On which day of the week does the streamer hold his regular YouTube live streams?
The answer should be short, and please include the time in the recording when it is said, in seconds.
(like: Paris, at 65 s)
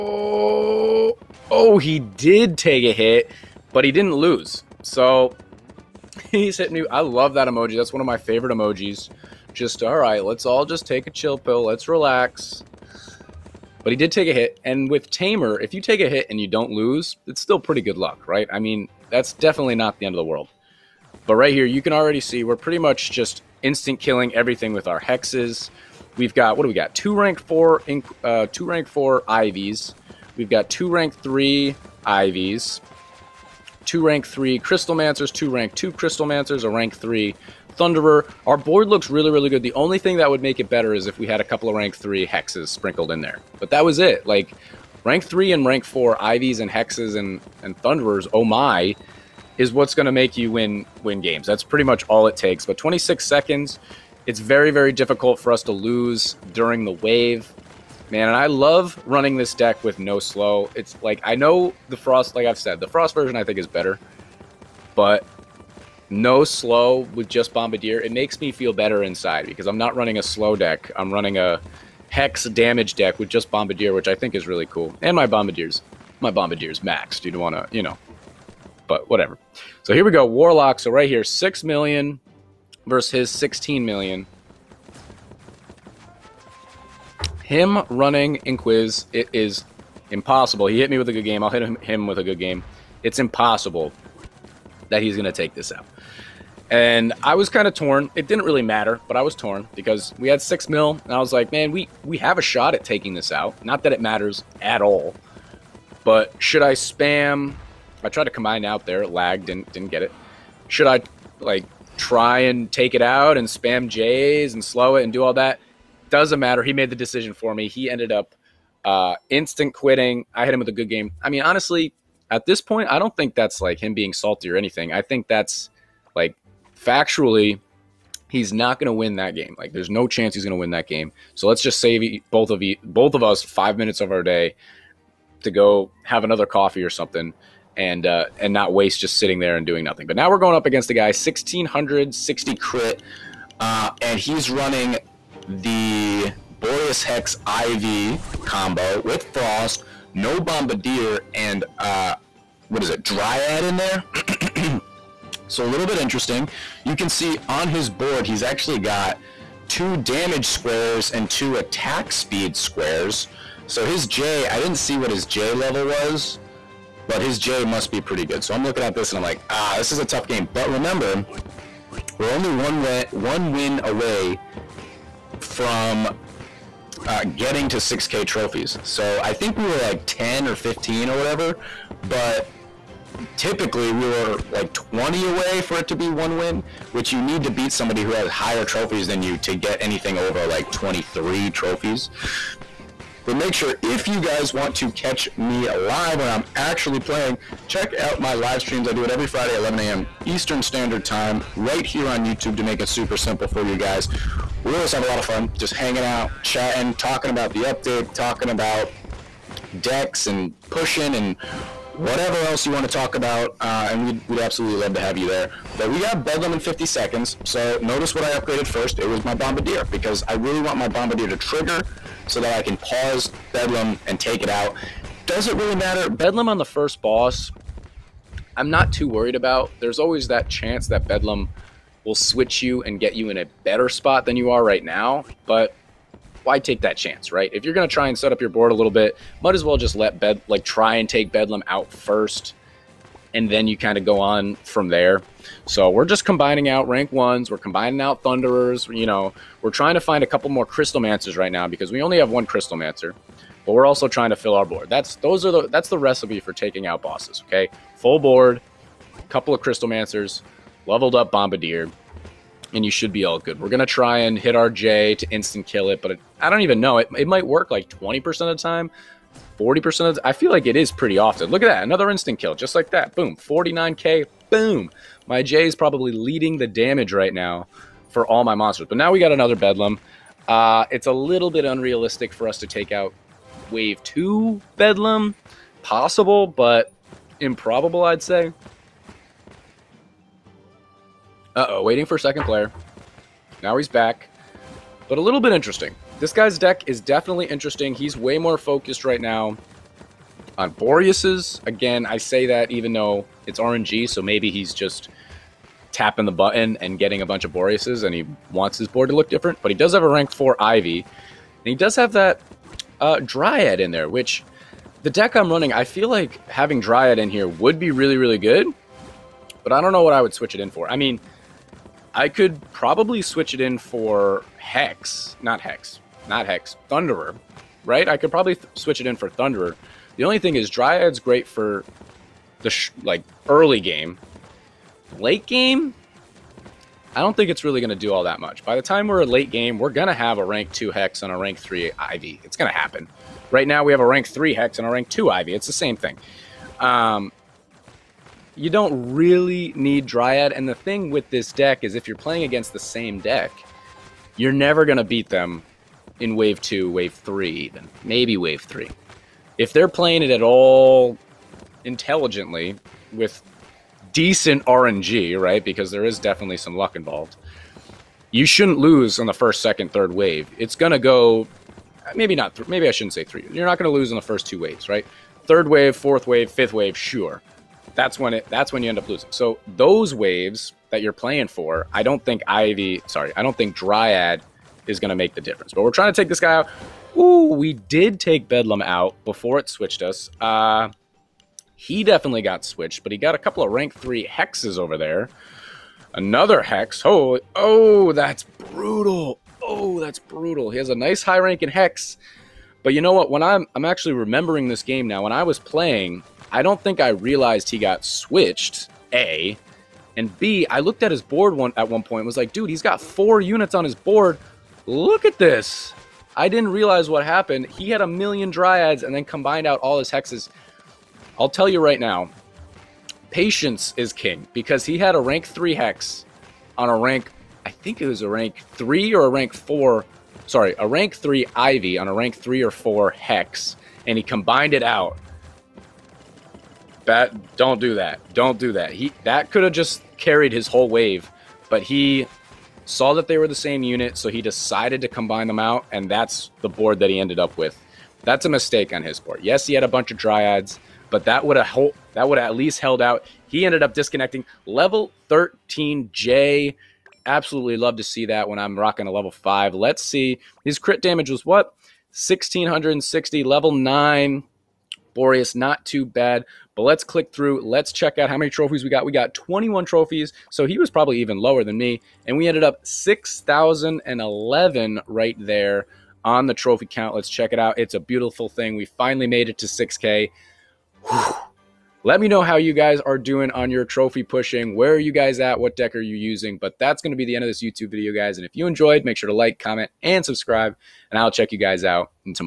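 Friday, at 199 s.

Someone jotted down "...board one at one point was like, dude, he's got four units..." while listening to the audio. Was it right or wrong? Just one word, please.
right.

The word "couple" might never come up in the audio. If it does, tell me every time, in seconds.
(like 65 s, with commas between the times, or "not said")
41 s, 250 s, 259 s, 393 s.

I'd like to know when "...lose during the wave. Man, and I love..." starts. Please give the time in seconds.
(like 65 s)
55 s.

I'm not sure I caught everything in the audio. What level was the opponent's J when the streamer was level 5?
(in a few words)
13.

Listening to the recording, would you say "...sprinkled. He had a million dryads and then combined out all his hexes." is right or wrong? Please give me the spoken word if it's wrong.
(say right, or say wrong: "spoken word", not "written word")
wrong: "happened", not "sprinkled".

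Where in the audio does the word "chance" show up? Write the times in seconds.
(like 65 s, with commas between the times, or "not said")
130 s, 230 s, 236 s.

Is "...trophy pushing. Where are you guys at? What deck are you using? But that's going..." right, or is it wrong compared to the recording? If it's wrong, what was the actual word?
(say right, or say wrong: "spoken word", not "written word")
right.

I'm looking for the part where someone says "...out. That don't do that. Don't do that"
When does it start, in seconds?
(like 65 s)
434 s.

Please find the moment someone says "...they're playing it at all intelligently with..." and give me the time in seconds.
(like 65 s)
359 s.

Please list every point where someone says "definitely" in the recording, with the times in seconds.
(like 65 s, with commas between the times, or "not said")
19 s, 296 s, 366 s, 392 s.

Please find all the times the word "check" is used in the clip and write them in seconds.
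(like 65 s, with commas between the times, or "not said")
197 s, 467 s, 477 s, 491 s.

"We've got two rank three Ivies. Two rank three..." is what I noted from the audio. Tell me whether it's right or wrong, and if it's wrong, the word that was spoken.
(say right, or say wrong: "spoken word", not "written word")
right.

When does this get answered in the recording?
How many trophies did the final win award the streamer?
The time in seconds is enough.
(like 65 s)
469 s.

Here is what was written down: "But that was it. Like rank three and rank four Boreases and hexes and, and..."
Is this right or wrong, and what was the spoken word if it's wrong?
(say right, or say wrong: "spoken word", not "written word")
wrong: "Ivies", not "Boreases".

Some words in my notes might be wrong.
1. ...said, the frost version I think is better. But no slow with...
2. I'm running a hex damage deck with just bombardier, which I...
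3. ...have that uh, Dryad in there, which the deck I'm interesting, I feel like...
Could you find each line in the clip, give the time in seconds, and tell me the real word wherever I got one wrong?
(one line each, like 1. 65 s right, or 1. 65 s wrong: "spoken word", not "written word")
1. 62 s right
2. 70 s right
3. 311 s wrong: "running", not "interesting".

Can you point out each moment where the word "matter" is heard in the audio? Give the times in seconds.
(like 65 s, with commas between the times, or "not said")
98 s, 104 s, 116 s, 225 s.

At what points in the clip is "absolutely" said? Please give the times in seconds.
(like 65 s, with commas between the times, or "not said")
214 s, 457 s.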